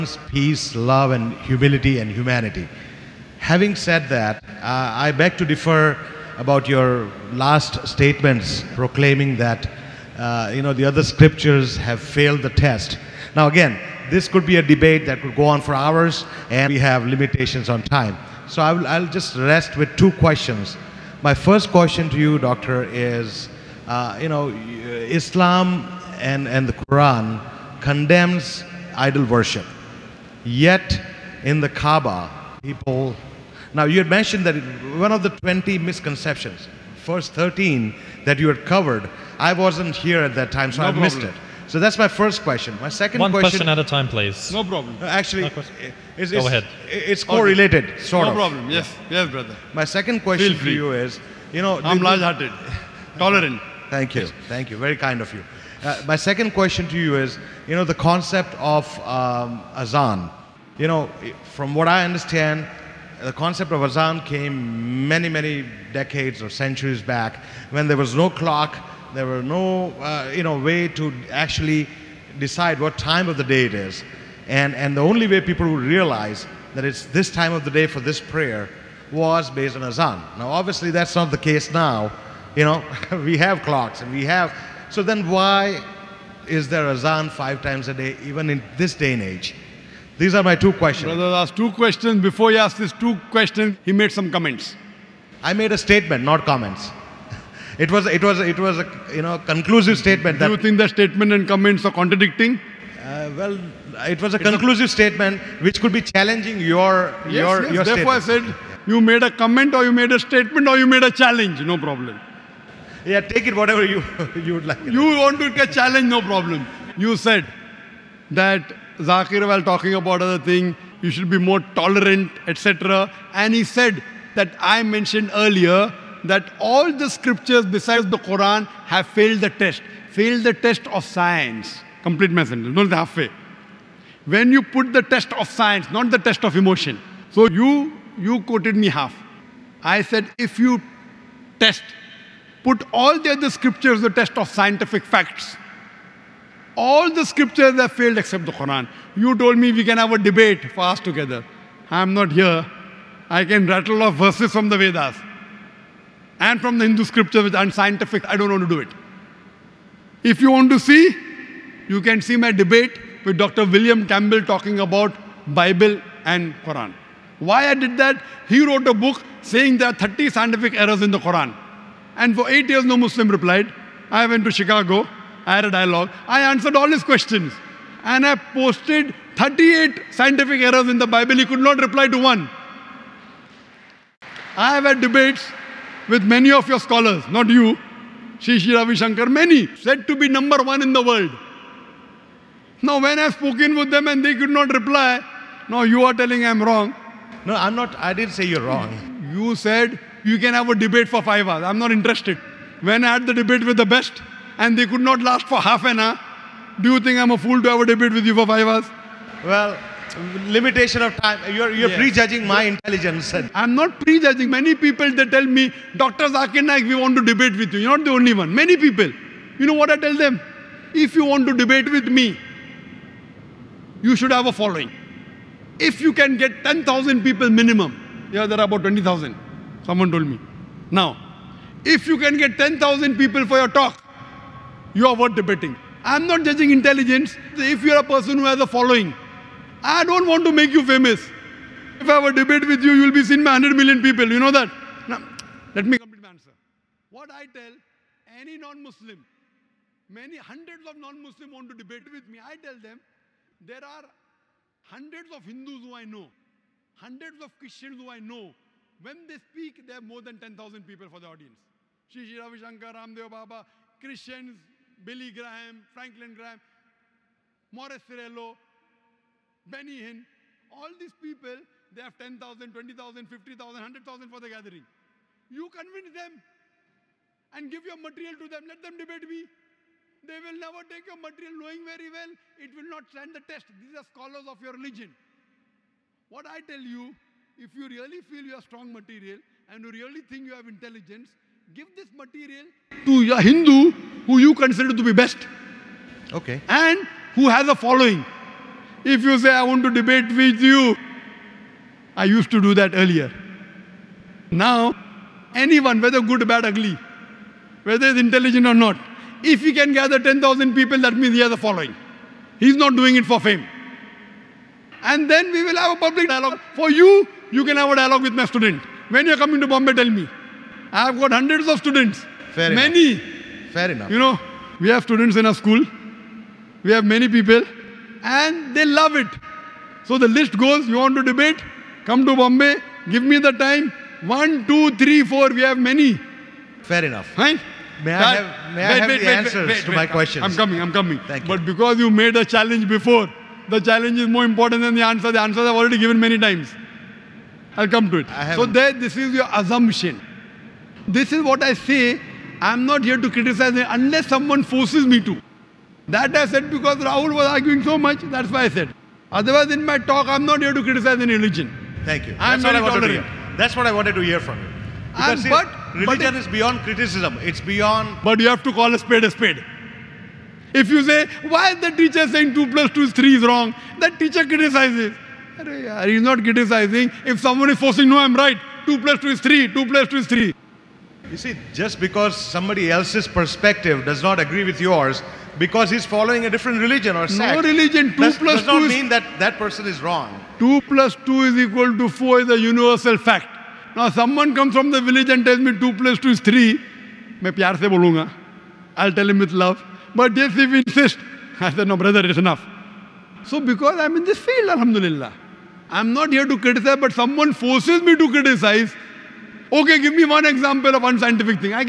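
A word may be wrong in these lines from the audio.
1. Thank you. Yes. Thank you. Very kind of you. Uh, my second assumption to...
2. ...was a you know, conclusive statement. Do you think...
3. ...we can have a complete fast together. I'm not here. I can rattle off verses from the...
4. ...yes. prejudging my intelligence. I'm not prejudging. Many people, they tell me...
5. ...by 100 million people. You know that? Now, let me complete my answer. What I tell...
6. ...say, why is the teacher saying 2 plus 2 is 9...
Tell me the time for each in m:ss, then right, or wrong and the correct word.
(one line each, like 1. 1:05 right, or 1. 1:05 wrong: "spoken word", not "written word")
1. 0:53 wrong: "question", not "assumption"
2. 1:38 right
3. 2:29 wrong: "debate", not "complete"
4. 3:31 right
5. 4:03 right
6. 6:11 wrong: "3", not "9".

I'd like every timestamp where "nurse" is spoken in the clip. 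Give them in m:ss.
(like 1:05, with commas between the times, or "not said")
not said.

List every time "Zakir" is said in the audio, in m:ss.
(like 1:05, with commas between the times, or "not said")
1:58, 3:36.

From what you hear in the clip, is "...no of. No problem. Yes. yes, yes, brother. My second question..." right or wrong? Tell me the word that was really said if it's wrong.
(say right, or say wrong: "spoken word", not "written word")
right.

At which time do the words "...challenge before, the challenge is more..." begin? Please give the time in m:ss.
5:42.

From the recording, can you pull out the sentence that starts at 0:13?
Now again, this could be a debate that could go on for hours and we have limitations on time.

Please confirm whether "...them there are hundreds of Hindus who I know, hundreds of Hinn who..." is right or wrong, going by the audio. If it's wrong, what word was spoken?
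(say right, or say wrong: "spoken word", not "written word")
wrong: "Christians", not "Hinn".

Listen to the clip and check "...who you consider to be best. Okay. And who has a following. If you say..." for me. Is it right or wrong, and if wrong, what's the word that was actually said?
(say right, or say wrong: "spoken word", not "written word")
right.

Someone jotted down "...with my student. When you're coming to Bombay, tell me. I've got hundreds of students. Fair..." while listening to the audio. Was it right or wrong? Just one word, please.
right.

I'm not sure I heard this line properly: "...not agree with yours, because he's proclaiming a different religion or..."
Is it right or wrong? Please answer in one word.
wrong.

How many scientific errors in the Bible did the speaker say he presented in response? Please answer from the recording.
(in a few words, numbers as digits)
38.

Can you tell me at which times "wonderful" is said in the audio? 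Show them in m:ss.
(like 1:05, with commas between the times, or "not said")
not said.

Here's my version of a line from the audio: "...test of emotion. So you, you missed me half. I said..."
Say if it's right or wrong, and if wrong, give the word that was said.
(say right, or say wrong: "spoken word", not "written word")
wrong: "quoted", not "missed".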